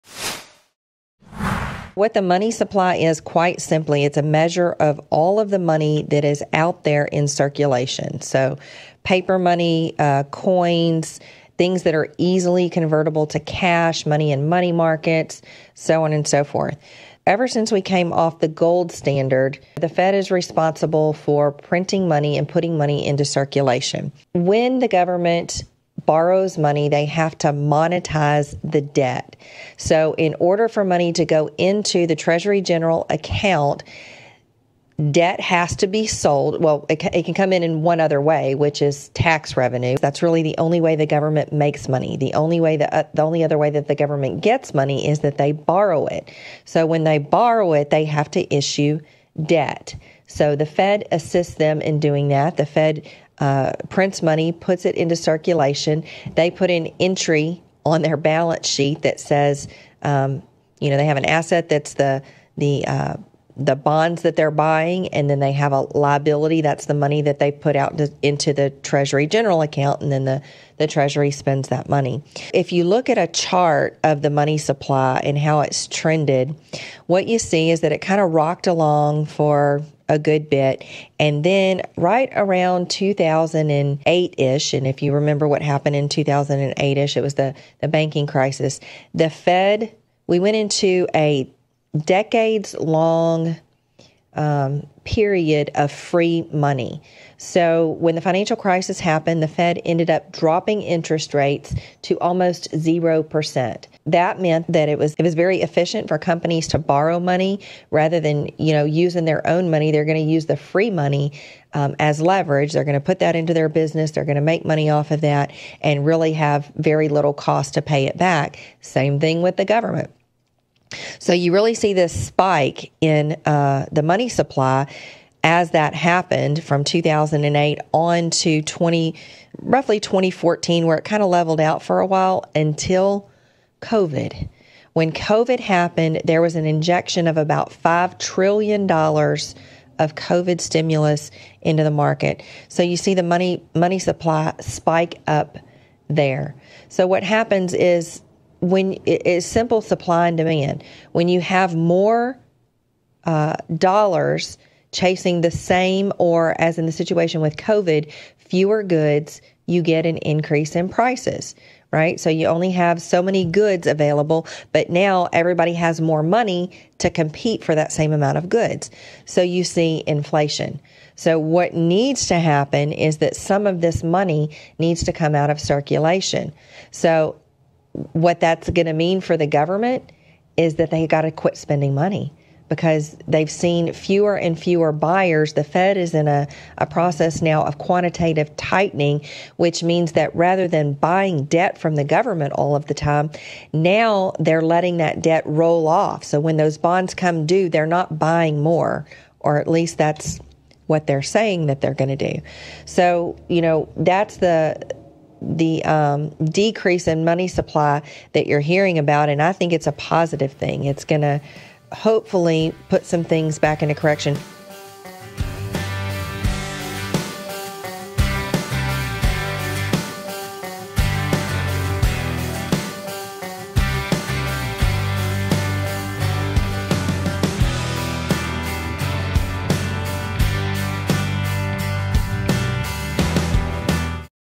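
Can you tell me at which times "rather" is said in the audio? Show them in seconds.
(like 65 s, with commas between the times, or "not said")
107 s, 190 s.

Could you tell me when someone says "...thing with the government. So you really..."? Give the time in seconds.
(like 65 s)
119 s.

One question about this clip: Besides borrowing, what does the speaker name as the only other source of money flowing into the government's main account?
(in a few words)
Tax revenue.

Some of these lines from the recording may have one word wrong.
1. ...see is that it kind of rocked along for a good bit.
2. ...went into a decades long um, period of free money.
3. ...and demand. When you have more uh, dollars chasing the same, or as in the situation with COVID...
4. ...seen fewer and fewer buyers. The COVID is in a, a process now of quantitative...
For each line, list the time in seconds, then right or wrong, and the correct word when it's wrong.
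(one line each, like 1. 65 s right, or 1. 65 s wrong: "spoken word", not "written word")
1. 77 s right
2. 90 s right
3. 150 s right
4. 183 s wrong: "Fed", not "COVID".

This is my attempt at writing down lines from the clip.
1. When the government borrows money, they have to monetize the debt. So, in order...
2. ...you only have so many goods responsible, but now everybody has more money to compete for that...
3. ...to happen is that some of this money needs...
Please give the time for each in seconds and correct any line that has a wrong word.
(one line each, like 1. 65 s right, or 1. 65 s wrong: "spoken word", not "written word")
1. 24 s right
2. 162 s wrong: "available", not "responsible"
3. 172 s right.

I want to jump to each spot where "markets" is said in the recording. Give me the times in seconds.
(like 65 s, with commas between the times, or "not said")
14 s, 141 s.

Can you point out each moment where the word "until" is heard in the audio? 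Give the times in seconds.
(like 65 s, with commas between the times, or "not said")
132 s.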